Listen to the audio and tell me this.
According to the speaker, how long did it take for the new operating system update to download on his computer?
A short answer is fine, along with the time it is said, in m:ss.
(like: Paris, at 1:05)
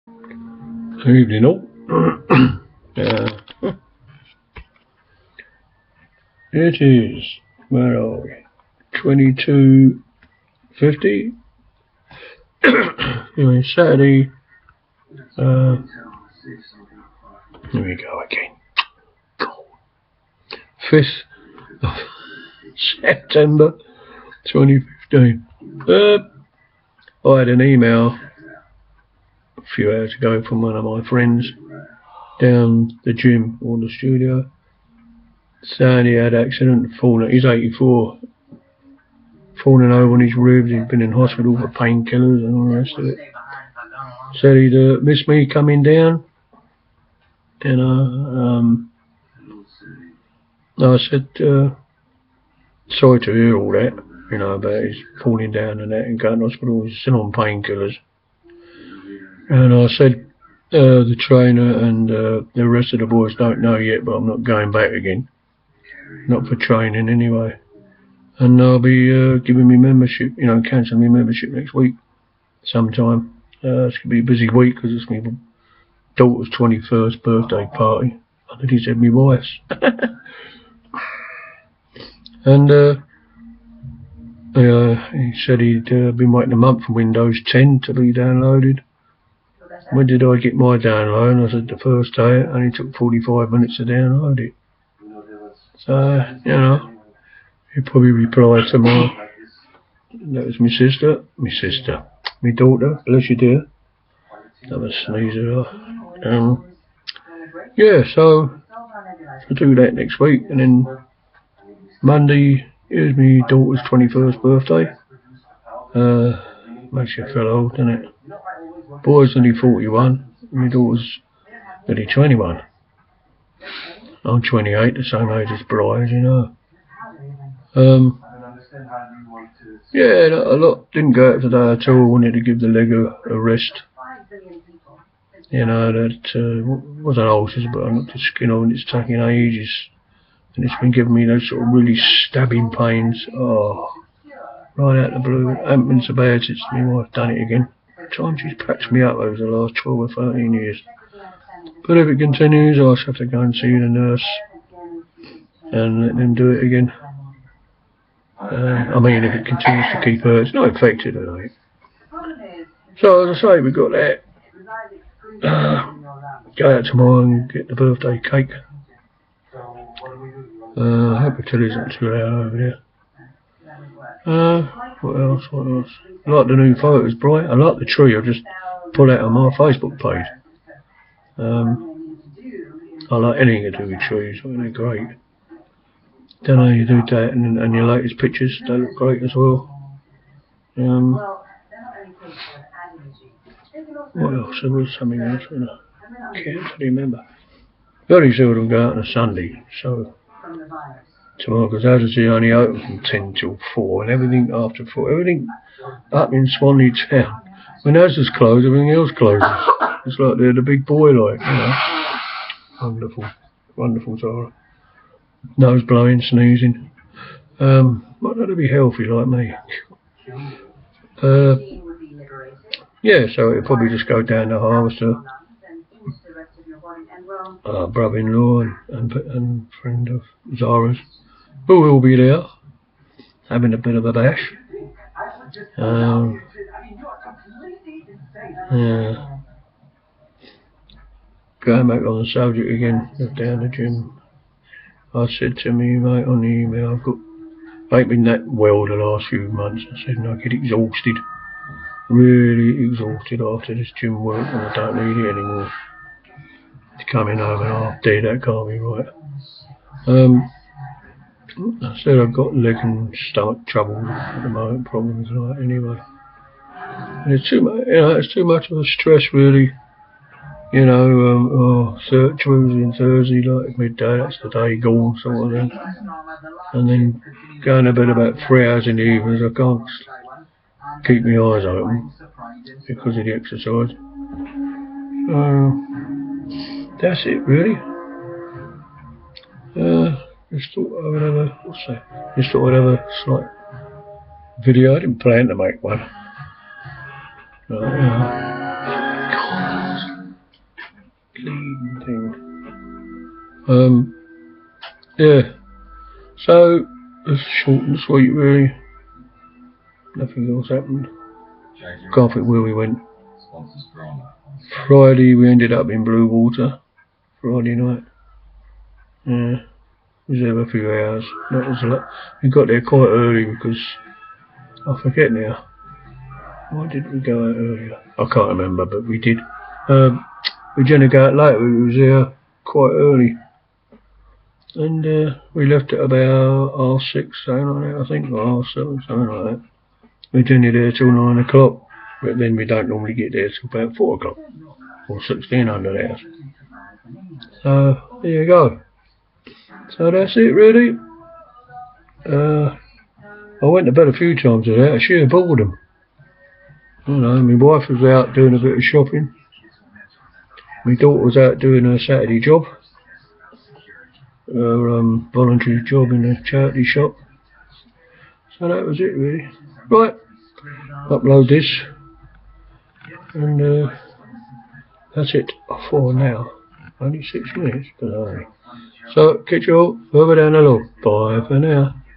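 45 minutes, at 1:32.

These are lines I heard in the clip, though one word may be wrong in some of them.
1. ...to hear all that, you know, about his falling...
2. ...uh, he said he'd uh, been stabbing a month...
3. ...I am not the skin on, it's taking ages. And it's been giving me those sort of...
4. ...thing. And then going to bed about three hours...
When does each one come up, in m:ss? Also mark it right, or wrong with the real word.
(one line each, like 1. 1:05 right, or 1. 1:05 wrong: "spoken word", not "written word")
1. 0:53 right
2. 1:22 wrong: "waiting", not "stabbing"
3. 2:17 right
4. 4:35 right.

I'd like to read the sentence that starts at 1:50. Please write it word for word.
And then Monday is my daughter's 21st birthday.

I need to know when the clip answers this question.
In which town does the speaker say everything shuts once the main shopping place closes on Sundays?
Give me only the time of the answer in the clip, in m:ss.
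3:26.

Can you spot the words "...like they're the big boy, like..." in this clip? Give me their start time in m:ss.
3:30.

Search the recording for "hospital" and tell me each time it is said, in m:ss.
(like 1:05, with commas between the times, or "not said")
0:41, 0:56.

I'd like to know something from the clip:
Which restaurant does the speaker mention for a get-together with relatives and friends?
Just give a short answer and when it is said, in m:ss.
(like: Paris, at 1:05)
Harvester, at 3:44.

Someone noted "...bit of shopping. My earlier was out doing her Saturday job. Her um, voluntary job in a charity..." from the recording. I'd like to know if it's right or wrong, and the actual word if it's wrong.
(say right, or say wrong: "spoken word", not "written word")
wrong: "daughter", not "earlier".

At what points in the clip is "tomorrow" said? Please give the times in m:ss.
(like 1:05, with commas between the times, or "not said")
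1:38, 2:46, 3:21.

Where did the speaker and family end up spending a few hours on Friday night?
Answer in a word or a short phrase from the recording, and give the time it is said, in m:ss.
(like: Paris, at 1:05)
Bluewater, at 5:16.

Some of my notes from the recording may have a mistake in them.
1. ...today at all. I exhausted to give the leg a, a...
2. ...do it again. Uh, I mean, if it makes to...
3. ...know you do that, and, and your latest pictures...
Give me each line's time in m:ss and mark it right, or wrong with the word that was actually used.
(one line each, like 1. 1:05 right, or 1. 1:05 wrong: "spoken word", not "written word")
1. 2:11 wrong: "wanted", not "exhausted"
2. 2:36 wrong: "continues", not "makes"
3. 3:06 right.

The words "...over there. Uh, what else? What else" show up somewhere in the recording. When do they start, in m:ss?
2:52.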